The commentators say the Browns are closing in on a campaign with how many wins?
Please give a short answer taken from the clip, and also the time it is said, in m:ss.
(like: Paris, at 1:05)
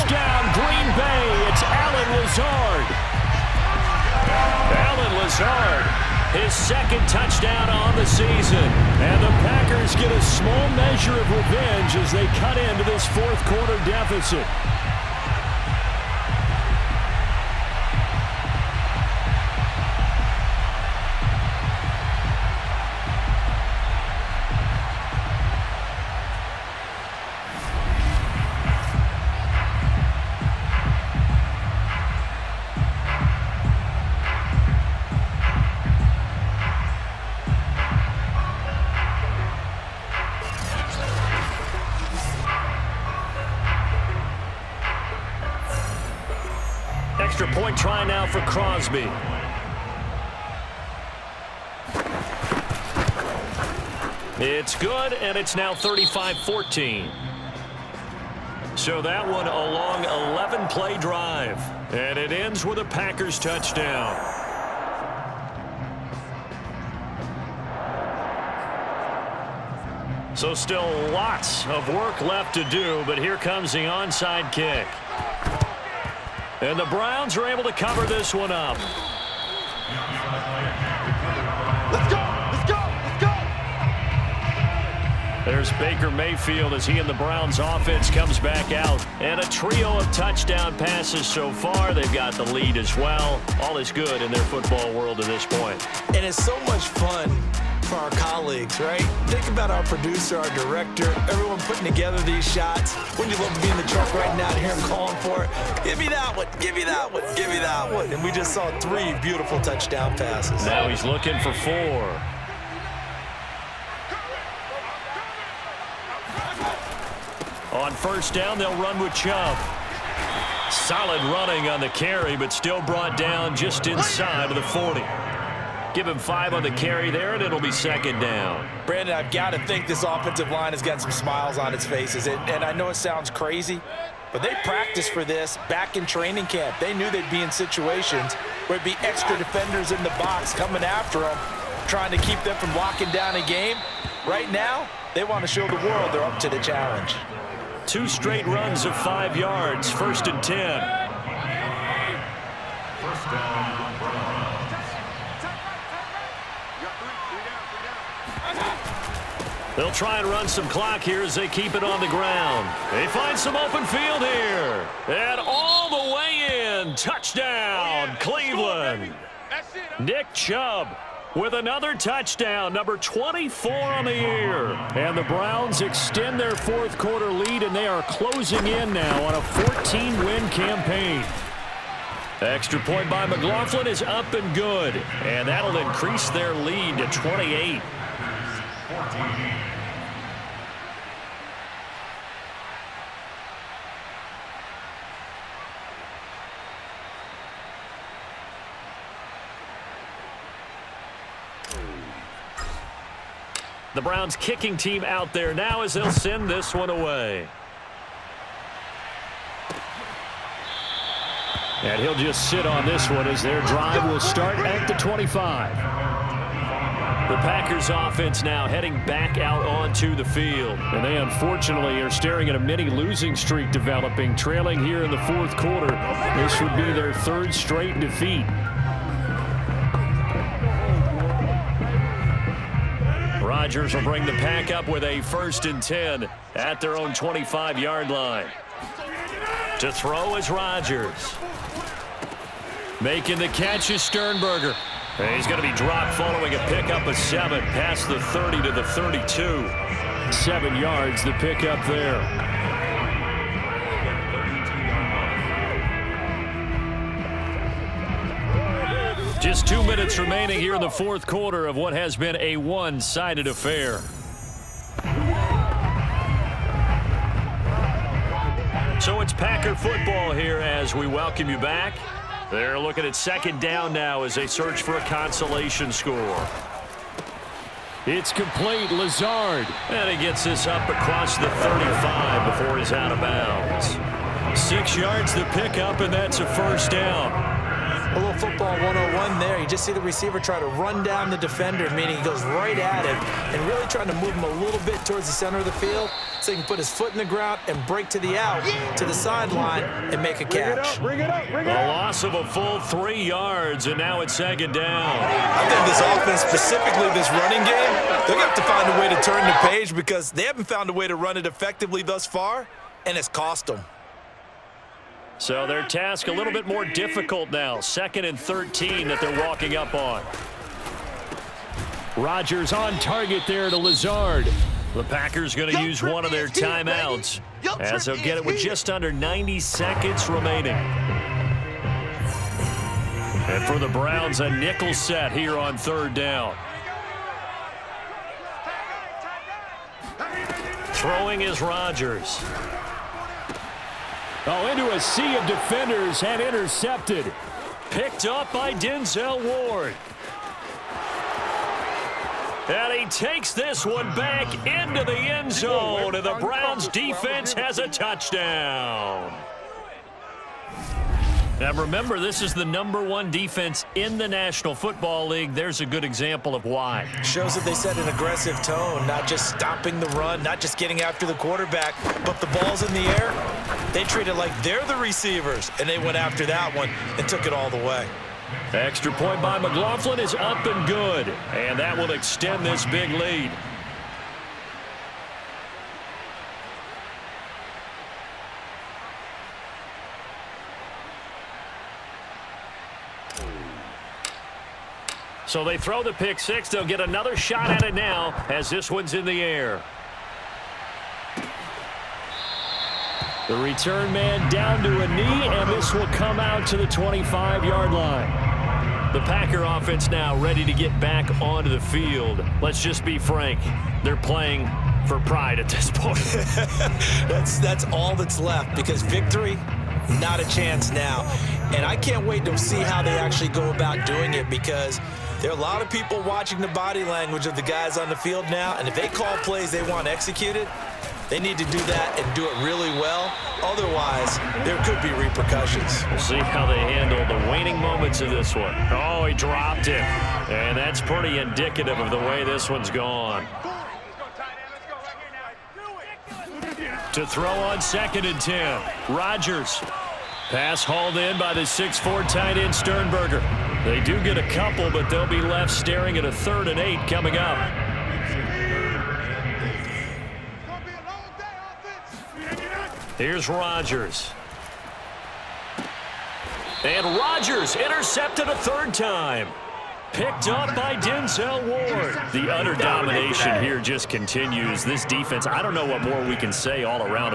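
14, at 2:59.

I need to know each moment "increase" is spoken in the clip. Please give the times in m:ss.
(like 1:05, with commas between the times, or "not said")
3:05.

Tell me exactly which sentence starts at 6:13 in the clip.
They treat it like they're the receivers, and they went after that one and took it all the way.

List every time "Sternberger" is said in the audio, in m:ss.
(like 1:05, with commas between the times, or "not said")
4:04, 7:32.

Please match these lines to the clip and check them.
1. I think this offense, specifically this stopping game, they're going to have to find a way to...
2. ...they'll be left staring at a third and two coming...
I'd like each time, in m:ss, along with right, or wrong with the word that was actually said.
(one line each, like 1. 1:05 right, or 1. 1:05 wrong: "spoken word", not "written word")
1. 5:05 wrong: "running", not "stopping"
2. 7:35 wrong: "eight", not "two".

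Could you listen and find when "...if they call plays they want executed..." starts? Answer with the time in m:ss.
7:08.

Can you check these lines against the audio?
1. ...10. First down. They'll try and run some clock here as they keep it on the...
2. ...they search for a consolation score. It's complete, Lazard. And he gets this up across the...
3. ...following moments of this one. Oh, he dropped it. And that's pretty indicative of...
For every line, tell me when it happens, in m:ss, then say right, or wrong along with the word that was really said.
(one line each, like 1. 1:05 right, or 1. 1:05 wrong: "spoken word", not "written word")
1. 2:30 right
2. 4:34 right
3. 7:17 wrong: "waning", not "following".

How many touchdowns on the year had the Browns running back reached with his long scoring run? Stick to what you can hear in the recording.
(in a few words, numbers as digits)
24.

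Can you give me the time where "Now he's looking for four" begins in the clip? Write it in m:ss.
1:50.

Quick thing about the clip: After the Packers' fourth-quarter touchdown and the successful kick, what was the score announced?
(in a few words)
35-14.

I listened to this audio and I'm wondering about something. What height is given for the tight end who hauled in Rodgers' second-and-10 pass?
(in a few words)
6'4.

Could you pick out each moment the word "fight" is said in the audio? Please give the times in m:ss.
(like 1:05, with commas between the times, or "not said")
not said.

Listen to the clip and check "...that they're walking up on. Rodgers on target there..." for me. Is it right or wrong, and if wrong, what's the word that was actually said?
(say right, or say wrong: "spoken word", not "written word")
right.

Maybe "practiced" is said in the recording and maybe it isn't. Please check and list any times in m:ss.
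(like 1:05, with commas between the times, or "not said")
2:14.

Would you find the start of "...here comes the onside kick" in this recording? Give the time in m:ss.
1:13.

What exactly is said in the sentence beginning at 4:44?
Six yards to pick up, and that's a first down.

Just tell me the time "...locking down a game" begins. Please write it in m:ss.
2:22.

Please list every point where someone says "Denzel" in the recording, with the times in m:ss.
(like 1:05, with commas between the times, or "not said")
5:48, 7:50.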